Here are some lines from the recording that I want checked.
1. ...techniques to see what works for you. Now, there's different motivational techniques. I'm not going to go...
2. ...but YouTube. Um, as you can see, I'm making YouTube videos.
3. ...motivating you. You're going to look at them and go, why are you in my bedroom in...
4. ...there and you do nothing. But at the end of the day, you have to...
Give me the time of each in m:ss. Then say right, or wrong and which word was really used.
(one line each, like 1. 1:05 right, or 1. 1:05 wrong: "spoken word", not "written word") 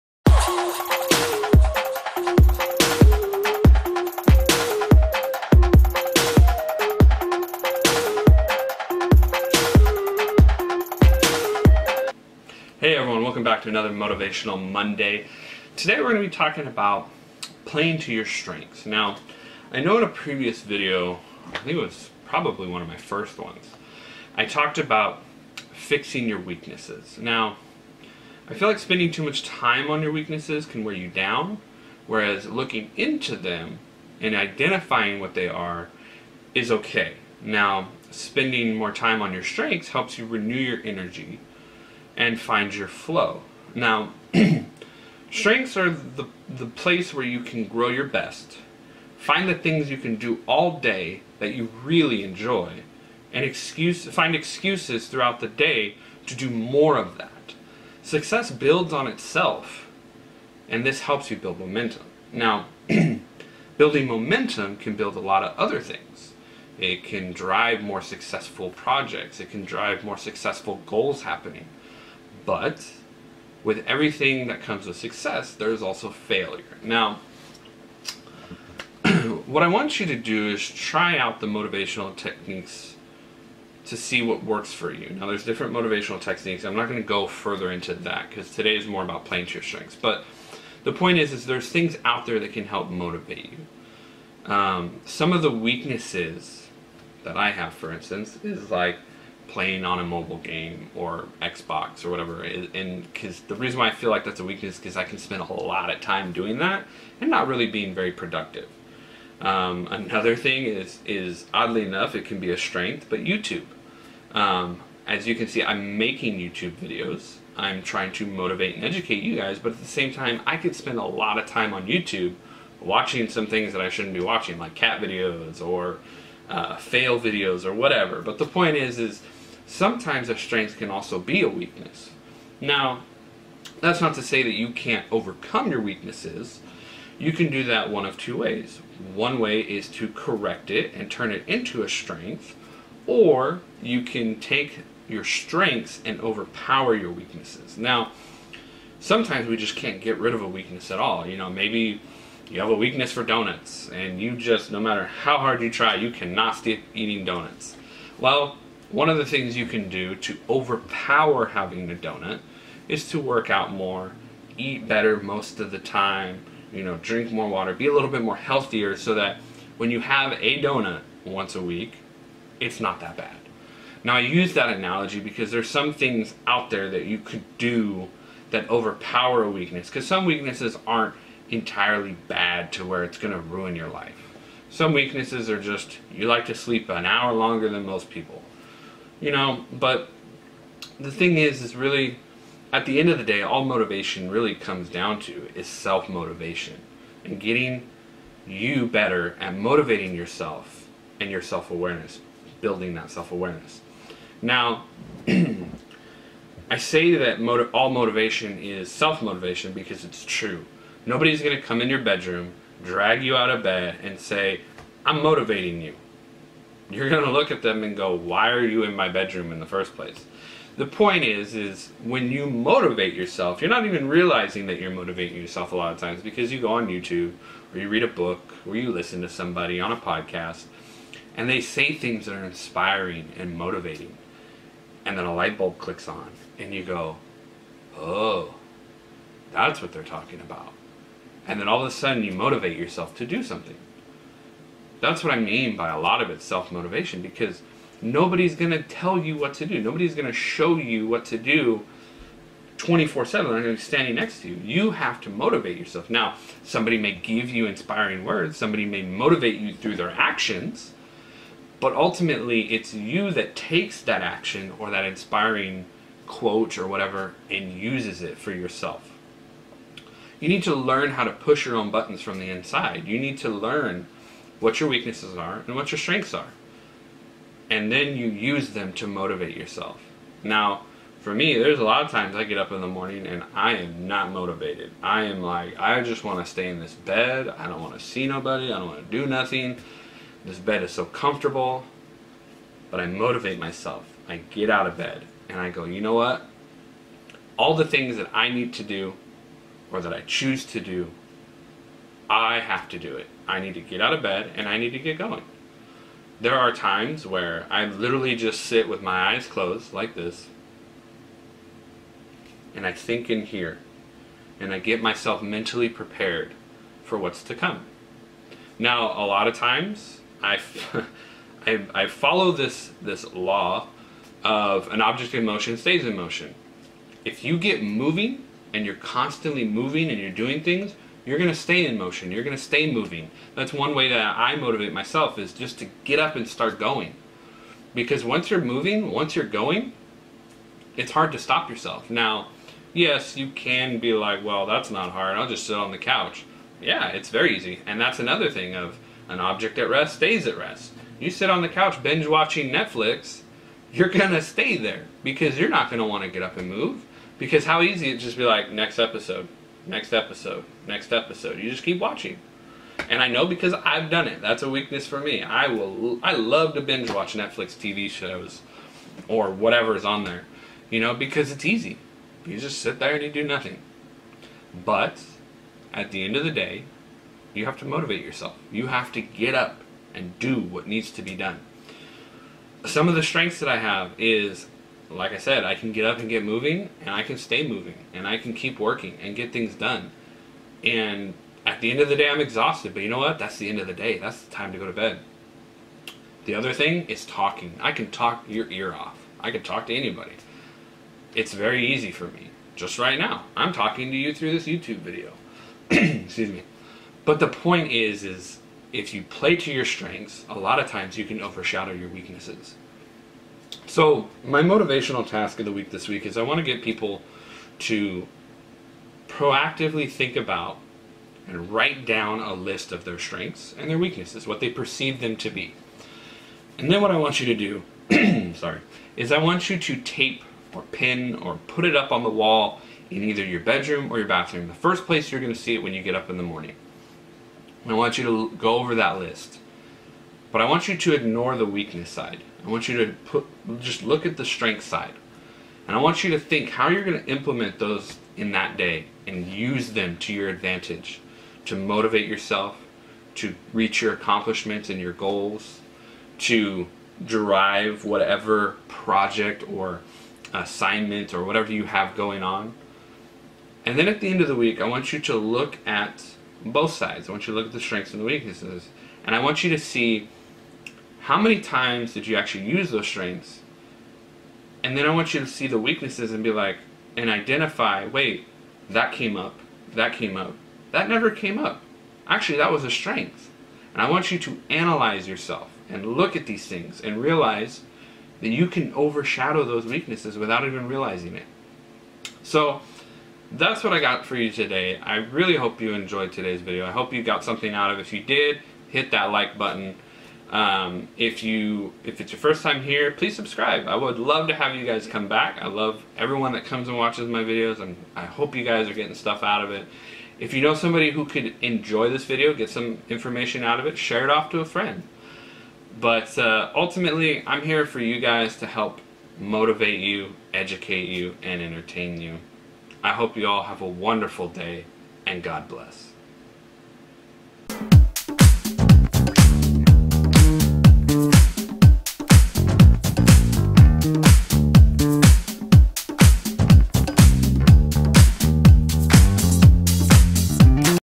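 1. 1:22 right
2. 1:53 right
3. 3:35 right
4. 6:12 right.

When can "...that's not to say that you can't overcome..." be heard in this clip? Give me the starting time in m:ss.
2:13.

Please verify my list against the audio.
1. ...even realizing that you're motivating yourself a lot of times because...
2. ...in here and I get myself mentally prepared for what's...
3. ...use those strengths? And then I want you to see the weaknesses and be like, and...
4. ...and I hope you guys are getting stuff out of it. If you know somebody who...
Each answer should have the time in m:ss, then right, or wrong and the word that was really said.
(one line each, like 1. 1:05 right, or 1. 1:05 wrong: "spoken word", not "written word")
1. 3:43 right
2. 5:13 right
3. 7:52 right
4. 8:27 right.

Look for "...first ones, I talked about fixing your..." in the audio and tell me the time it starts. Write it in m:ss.
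0:22.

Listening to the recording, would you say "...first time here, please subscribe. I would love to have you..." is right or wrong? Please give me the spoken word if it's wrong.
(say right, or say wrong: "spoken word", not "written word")
right.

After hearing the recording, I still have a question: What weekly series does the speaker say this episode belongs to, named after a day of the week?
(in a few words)
Motivational Monday.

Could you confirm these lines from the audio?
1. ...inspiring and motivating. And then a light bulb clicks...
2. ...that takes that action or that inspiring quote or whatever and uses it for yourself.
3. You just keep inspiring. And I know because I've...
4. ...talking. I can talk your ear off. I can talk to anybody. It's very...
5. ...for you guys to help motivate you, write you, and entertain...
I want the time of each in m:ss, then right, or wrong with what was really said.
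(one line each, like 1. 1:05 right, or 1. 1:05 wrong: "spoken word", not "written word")
1. 3:52 right
2. 4:23 right
3. 6:01 wrong: "watching", not "inspiring"
4. 6:37 right
5. 8:37 wrong: "educate", not "write".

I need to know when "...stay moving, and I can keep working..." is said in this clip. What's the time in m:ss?
6:27.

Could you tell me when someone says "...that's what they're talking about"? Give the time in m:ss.
3:59.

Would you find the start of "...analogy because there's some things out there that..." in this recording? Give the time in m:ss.
2:54.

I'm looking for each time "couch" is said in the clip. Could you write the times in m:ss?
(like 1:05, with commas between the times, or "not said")
5:45, 5:51.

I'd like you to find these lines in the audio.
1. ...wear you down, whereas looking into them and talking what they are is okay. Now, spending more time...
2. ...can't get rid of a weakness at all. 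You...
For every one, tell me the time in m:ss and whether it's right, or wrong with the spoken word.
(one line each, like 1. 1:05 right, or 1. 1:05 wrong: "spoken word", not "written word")
1. 0:30 wrong: "identifying", not "talking"
2. 2:29 right.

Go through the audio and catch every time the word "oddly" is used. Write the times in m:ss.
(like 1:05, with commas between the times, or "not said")
1:51.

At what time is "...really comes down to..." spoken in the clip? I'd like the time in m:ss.
3:14.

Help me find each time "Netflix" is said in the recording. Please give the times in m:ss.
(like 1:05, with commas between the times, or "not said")
5:52, 6:07.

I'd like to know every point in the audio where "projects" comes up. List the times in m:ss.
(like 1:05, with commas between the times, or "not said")
1:08, 7:38.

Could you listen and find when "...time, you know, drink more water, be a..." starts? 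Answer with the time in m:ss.
2:45.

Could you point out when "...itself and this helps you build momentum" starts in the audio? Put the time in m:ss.
0:59.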